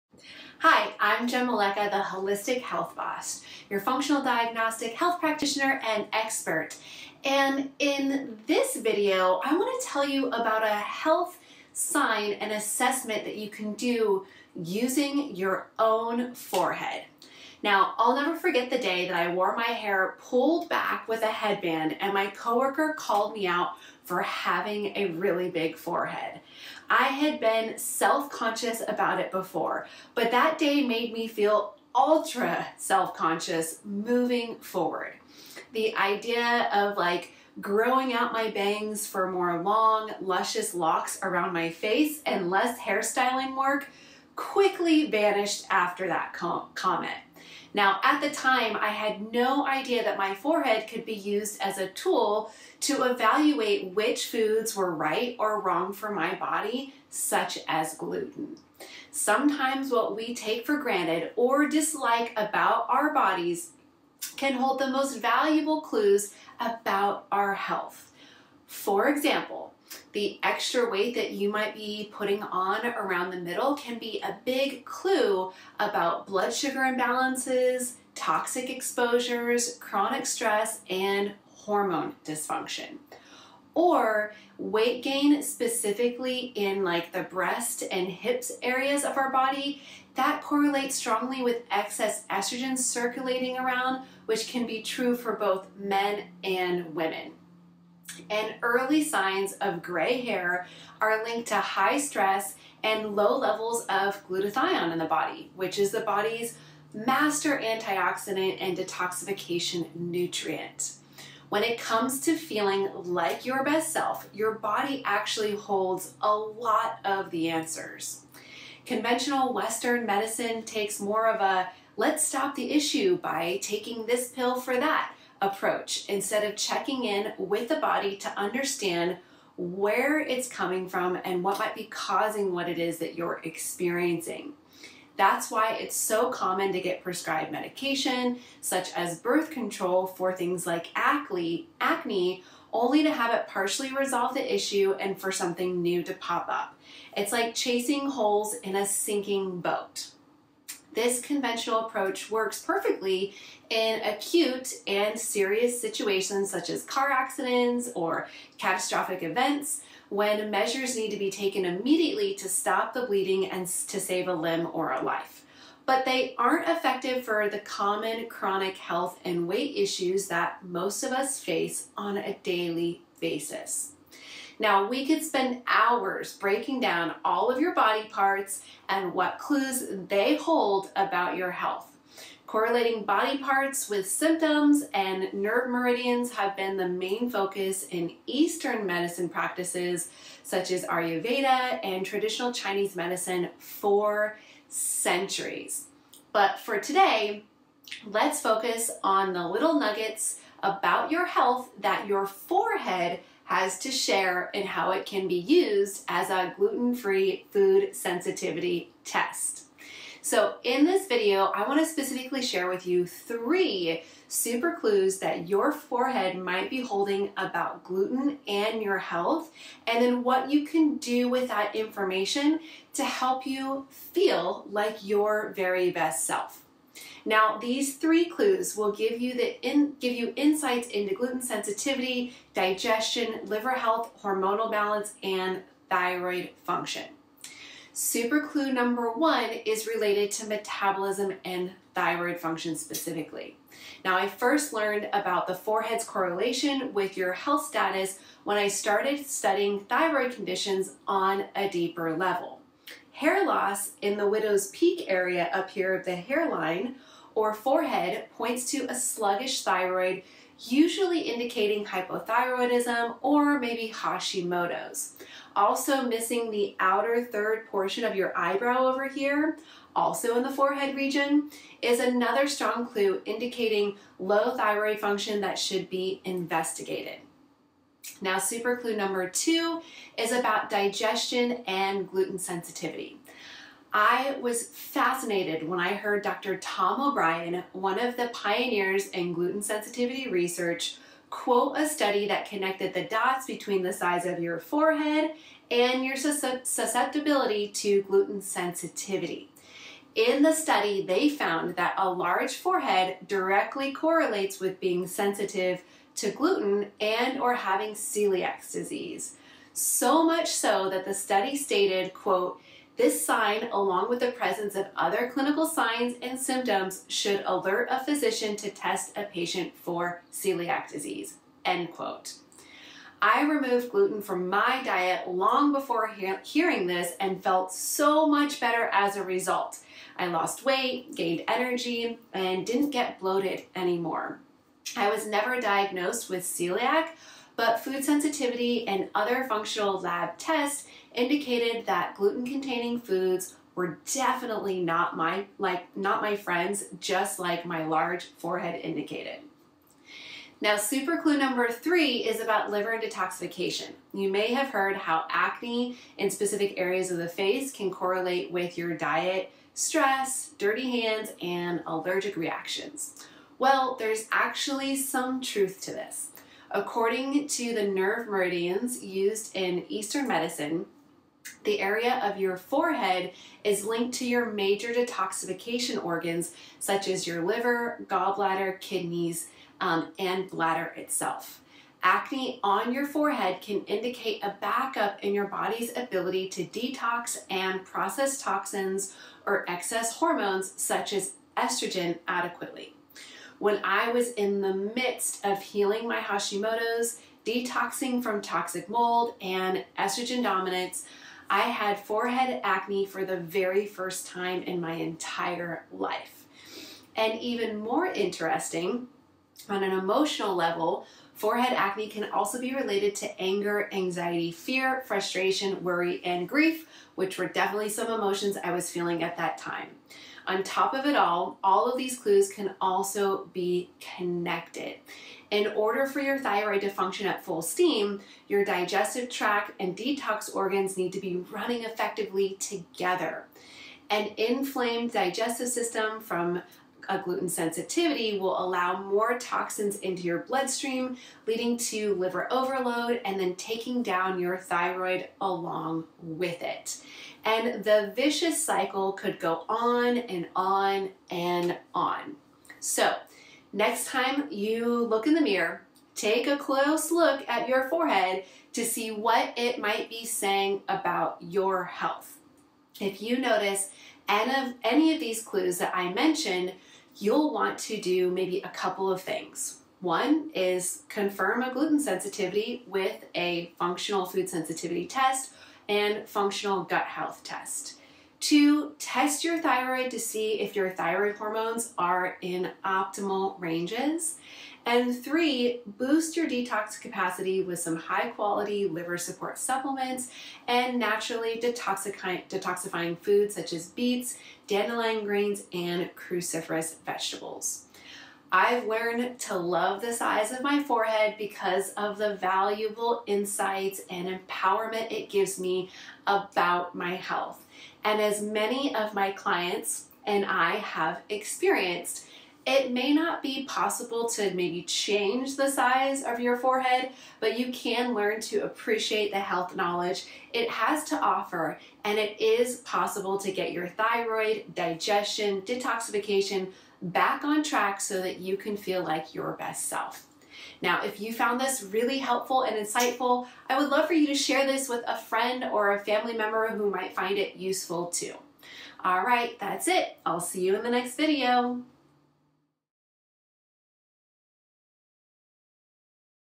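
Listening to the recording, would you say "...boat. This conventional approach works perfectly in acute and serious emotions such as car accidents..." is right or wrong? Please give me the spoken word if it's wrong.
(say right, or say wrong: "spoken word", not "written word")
wrong: "situations", not "emotions".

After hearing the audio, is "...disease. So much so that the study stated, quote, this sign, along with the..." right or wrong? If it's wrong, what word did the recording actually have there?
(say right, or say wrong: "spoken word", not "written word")
right.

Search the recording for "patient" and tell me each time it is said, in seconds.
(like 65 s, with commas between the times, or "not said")
319 s.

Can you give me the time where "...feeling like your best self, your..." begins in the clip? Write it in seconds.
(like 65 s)
112 s.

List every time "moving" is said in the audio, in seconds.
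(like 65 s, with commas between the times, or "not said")
33 s.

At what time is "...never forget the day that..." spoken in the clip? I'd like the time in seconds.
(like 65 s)
18 s.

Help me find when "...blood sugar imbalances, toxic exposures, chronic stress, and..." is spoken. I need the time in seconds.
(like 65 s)
76 s.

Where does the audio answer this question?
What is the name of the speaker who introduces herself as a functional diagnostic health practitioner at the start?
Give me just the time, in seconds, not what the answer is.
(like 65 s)
1 s.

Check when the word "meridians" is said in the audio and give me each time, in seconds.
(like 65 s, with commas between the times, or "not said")
185 s, 368 s.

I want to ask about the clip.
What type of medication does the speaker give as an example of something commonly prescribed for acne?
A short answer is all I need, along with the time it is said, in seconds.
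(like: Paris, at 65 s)
birth control, at 139 s.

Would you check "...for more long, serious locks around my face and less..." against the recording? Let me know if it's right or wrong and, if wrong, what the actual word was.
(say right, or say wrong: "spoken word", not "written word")
wrong: "luscious", not "serious".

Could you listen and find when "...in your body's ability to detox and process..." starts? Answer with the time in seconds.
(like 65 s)
385 s.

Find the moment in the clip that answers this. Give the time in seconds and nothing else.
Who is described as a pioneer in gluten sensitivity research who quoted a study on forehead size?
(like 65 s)
286 s.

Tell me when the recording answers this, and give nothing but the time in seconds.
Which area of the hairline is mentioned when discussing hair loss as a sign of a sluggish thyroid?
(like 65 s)
254 s.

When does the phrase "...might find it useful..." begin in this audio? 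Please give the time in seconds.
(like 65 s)
536 s.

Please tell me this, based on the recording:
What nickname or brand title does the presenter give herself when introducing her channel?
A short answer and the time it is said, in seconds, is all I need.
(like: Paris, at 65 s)
Wholistic Health Boss, at 2 s.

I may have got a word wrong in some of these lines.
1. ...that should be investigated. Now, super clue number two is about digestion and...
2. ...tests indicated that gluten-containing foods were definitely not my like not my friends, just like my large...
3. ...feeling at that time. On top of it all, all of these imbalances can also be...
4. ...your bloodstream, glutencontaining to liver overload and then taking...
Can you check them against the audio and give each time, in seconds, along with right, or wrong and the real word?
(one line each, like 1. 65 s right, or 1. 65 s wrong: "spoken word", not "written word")
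1. 275 s right
2. 340 s right
3. 418 s wrong: "clues", not "imbalances"
4. 440 s wrong: "leading", not "glutencontaining".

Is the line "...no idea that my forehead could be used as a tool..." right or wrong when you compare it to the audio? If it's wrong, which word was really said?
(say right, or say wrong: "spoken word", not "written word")
right.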